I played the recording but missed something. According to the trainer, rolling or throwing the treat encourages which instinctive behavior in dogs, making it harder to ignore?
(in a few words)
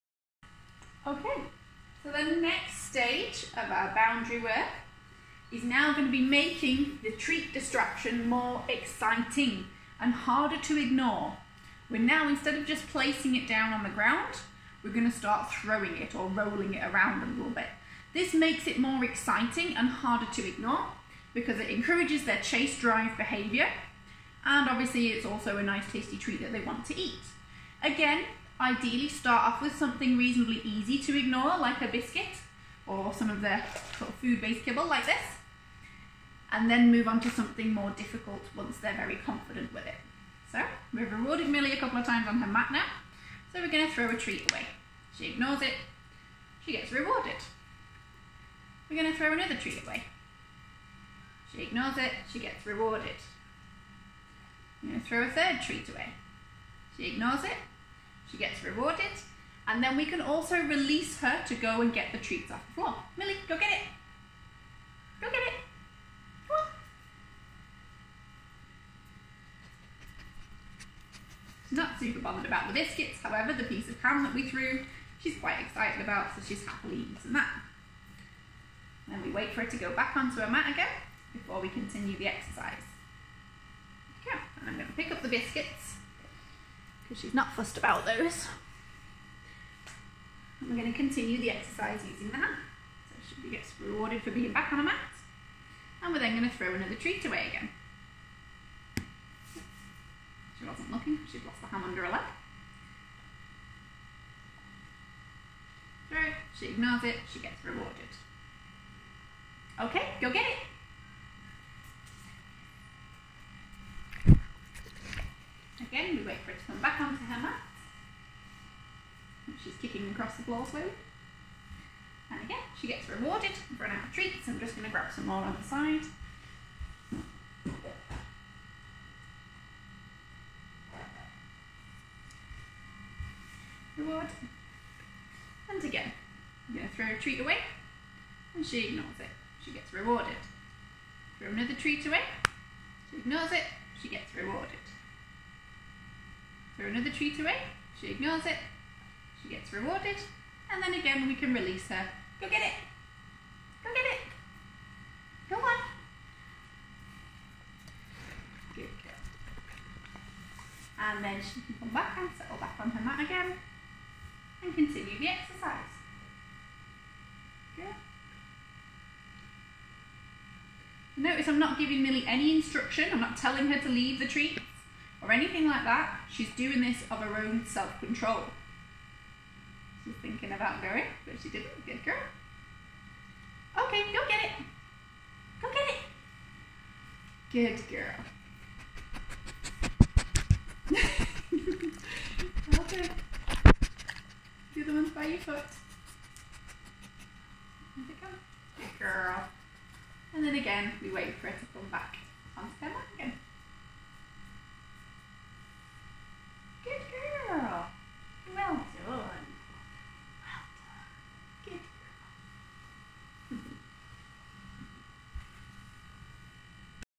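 chase drive.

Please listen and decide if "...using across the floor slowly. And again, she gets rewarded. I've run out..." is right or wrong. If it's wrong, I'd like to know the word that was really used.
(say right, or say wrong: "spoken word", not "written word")
wrong: "kicking", not "using".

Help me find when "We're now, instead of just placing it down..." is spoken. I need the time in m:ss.
0:11.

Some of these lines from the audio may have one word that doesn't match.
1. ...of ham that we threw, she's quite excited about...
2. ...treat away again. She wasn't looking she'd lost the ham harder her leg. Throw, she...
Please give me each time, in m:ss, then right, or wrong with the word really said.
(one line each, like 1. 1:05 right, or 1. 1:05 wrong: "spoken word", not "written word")
1. 1:13 right
2. 1:36 wrong: "under", not "harder".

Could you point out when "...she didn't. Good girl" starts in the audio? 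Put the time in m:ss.
3:01.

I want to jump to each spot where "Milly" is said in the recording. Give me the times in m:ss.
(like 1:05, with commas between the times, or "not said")
0:41, 1:03, 2:52.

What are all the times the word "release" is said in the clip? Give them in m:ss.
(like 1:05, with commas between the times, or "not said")
1:00, 2:31.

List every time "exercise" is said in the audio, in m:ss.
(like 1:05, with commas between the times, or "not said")
1:22, 1:31, 2:45.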